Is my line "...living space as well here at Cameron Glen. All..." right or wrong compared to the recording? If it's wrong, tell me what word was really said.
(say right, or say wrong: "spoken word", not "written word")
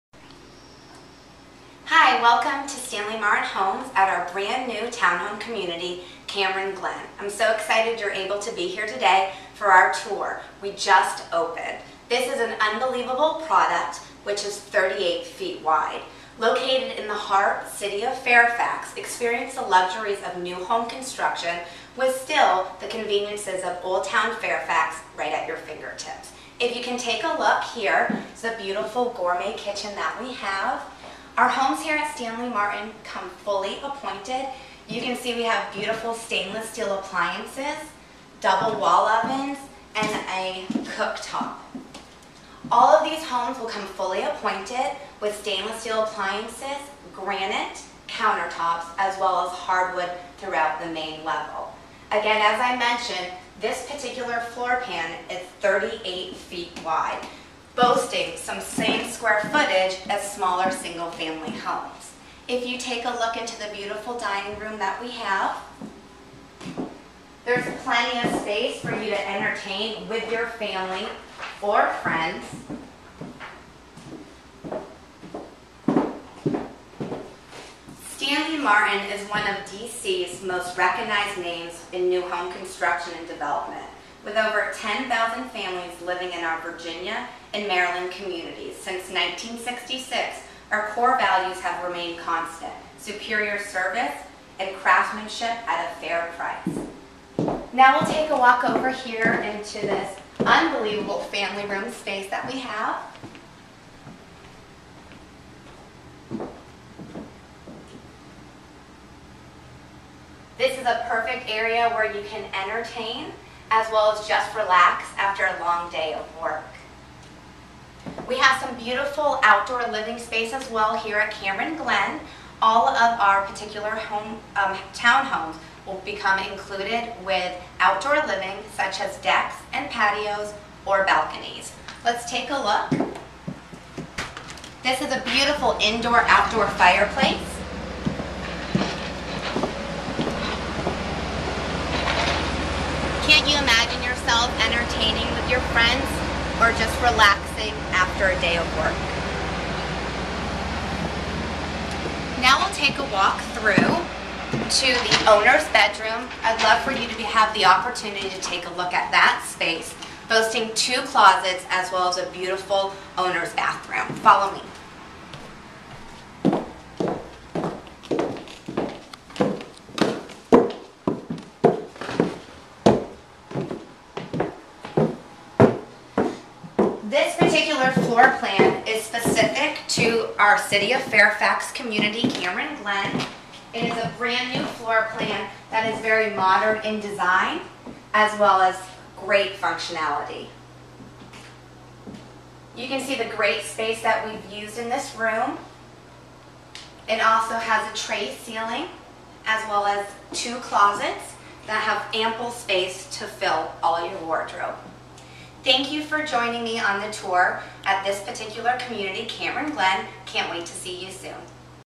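right.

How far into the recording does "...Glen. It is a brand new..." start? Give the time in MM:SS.
03:02.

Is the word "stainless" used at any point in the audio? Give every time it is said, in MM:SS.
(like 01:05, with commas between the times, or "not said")
00:36, 00:45.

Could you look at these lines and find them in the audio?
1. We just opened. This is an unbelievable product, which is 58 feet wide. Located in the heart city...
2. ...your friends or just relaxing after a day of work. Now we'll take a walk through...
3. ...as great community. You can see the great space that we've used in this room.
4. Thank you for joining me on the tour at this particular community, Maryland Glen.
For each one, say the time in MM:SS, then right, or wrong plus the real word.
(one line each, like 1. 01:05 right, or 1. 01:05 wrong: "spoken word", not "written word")
1. 00:10 wrong: "38", not "58"
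2. 02:25 right
3. 03:08 wrong: "functionality", not "community"
4. 03:25 wrong: "Cameron", not "Maryland".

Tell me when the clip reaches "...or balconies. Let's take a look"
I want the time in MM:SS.
02:10.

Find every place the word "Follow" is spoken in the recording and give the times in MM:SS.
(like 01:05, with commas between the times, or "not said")
02:44.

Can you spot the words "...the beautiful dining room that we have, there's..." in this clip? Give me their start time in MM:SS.
01:03.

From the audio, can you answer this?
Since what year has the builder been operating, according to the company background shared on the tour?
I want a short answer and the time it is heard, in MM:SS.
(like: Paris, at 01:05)
1966, at 01:29.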